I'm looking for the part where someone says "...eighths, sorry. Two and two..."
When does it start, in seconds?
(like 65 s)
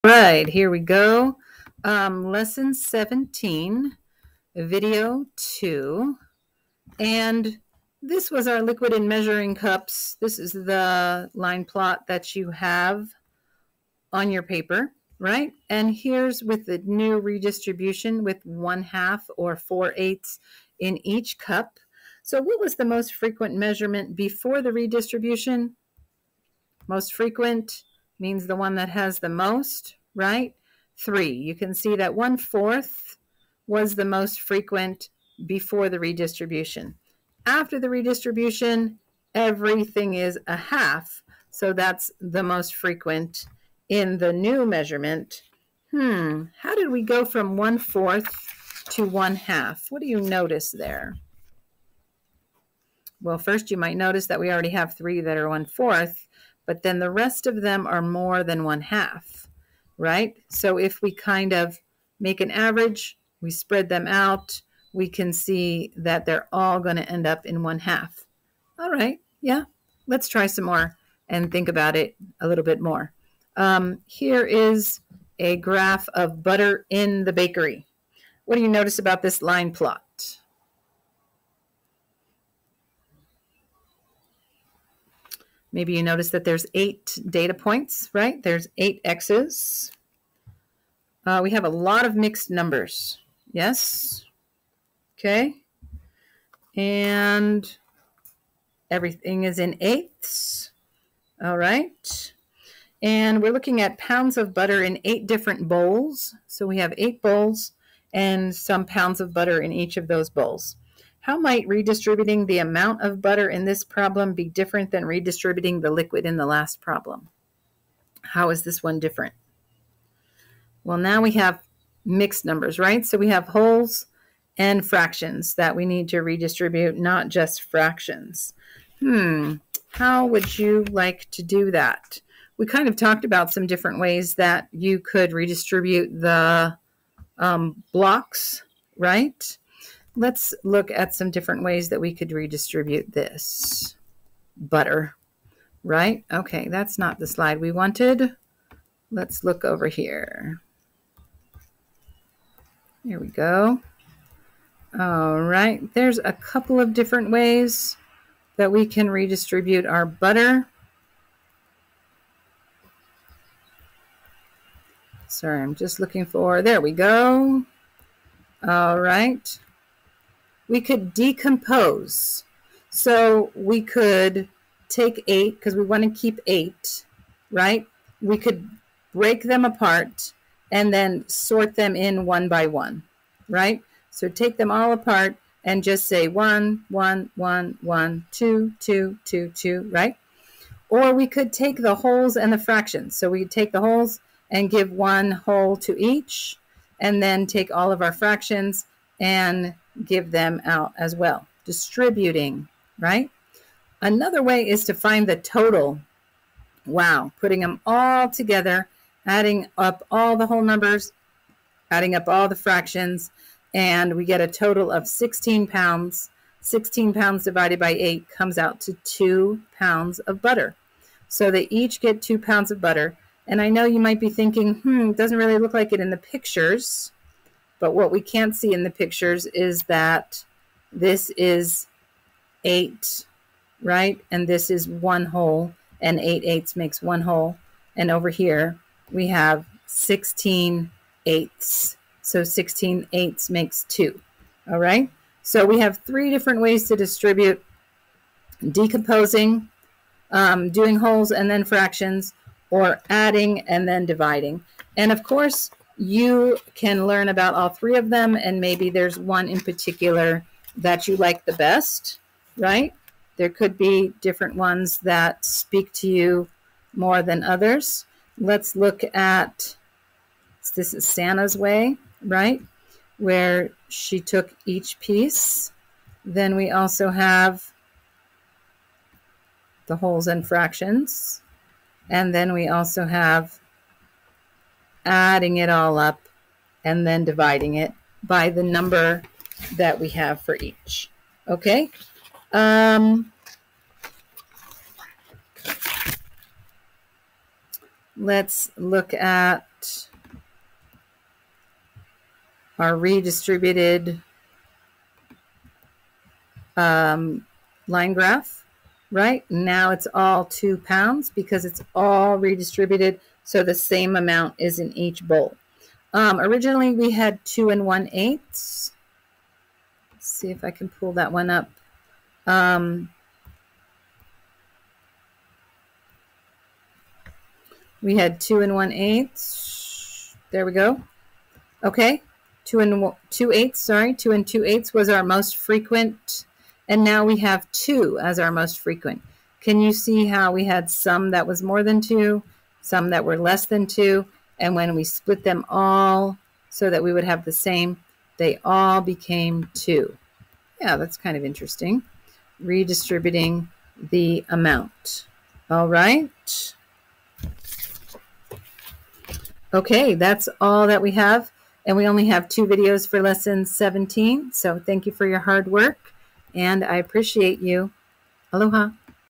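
333 s.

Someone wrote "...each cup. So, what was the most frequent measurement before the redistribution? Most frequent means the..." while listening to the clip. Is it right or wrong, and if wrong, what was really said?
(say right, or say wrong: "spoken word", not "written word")
right.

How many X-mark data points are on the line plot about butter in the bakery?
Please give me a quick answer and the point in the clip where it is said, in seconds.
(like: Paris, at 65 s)
8, at 86 s.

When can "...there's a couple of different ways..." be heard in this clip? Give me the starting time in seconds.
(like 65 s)
155 s.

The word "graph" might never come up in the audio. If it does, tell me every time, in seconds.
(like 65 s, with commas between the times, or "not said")
75 s, 308 s.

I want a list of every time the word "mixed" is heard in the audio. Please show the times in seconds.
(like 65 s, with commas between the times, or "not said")
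92 s, 122 s.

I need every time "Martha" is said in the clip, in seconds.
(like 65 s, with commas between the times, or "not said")
not said.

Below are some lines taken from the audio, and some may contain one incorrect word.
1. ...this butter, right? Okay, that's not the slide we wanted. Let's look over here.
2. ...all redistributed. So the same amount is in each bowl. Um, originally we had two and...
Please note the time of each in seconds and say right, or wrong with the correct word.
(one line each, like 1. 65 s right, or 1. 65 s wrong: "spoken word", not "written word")
1. 143 s right
2. 311 s right.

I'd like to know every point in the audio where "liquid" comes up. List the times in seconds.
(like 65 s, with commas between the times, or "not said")
8 s, 115 s.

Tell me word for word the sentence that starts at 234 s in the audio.
And this is one whole, and 8 eighths makes one whole.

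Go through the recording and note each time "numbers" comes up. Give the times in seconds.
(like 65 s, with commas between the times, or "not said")
92 s, 122 s, 210 s, 288 s.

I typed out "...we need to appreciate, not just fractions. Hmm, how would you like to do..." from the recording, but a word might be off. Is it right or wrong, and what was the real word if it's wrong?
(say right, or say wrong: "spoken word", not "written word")
wrong: "redistribute", not "appreciate".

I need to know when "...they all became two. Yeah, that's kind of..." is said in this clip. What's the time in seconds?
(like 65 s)
348 s.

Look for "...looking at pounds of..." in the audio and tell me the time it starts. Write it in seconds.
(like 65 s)
103 s.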